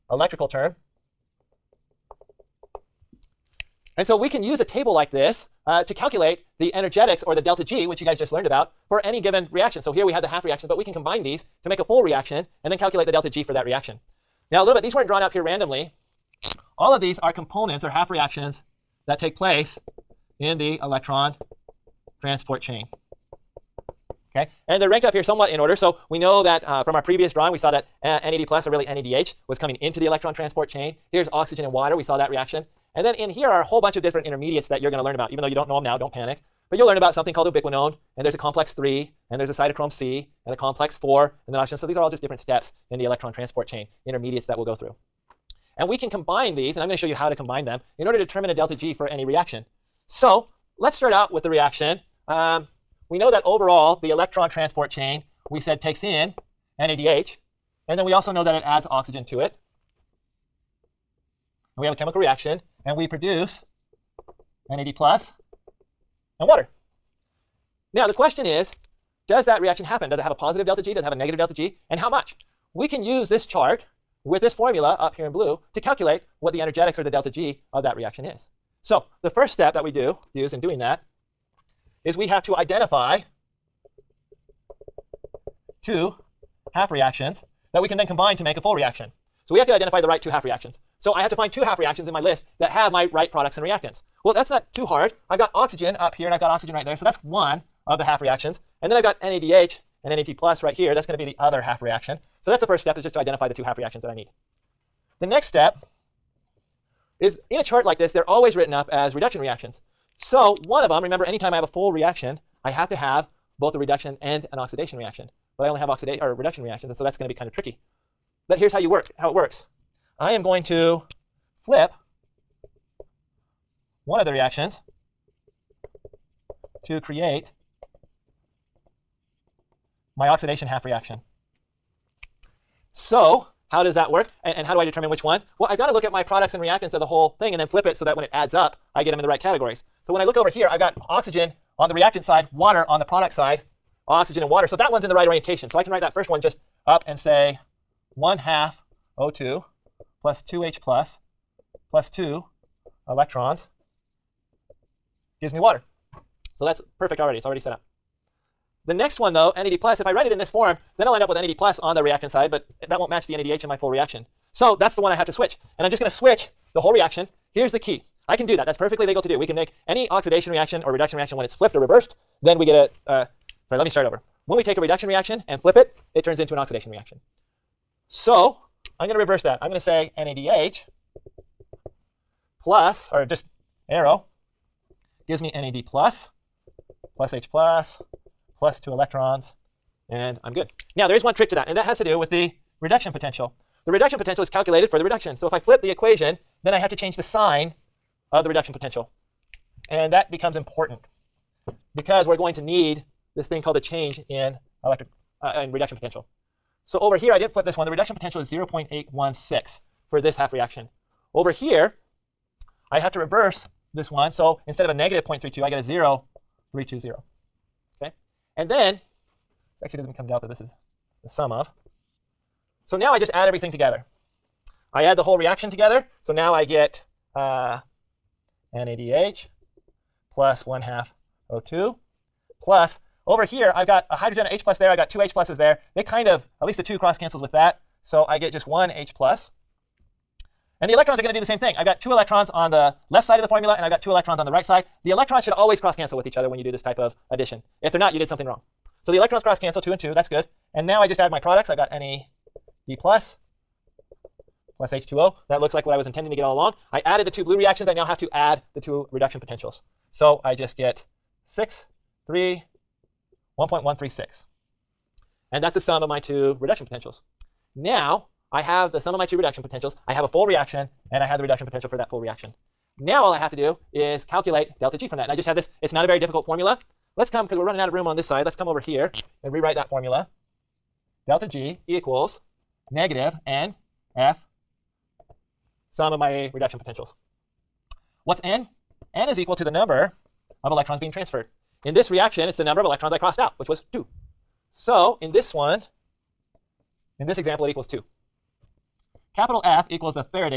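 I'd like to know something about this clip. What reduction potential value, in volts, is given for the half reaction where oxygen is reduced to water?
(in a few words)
0.816.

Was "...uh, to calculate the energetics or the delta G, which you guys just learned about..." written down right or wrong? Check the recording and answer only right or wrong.
right.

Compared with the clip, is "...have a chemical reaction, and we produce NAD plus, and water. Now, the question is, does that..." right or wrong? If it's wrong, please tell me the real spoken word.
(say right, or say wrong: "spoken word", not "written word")
right.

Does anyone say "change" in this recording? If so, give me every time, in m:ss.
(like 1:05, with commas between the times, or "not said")
3:16, 3:23.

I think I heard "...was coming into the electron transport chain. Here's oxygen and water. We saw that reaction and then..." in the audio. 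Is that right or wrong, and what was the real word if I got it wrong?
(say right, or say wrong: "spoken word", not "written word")
right.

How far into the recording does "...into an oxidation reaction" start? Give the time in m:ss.
2:56.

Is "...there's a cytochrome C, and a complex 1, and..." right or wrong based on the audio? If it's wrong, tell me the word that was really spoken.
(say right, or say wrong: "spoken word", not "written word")
wrong: "4", not "1".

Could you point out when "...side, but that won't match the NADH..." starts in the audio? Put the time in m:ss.
2:42.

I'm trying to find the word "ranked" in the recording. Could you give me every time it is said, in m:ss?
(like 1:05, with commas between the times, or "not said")
0:24.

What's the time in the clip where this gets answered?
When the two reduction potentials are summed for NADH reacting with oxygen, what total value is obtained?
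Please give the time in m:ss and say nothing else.
4:23.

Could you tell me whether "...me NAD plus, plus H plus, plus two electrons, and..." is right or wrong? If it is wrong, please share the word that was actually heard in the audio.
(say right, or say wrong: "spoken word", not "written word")
right.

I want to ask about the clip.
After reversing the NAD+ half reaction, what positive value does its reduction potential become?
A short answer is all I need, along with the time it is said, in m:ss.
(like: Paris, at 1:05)
0.320, at 3:35.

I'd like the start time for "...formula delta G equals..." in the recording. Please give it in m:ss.
4:39.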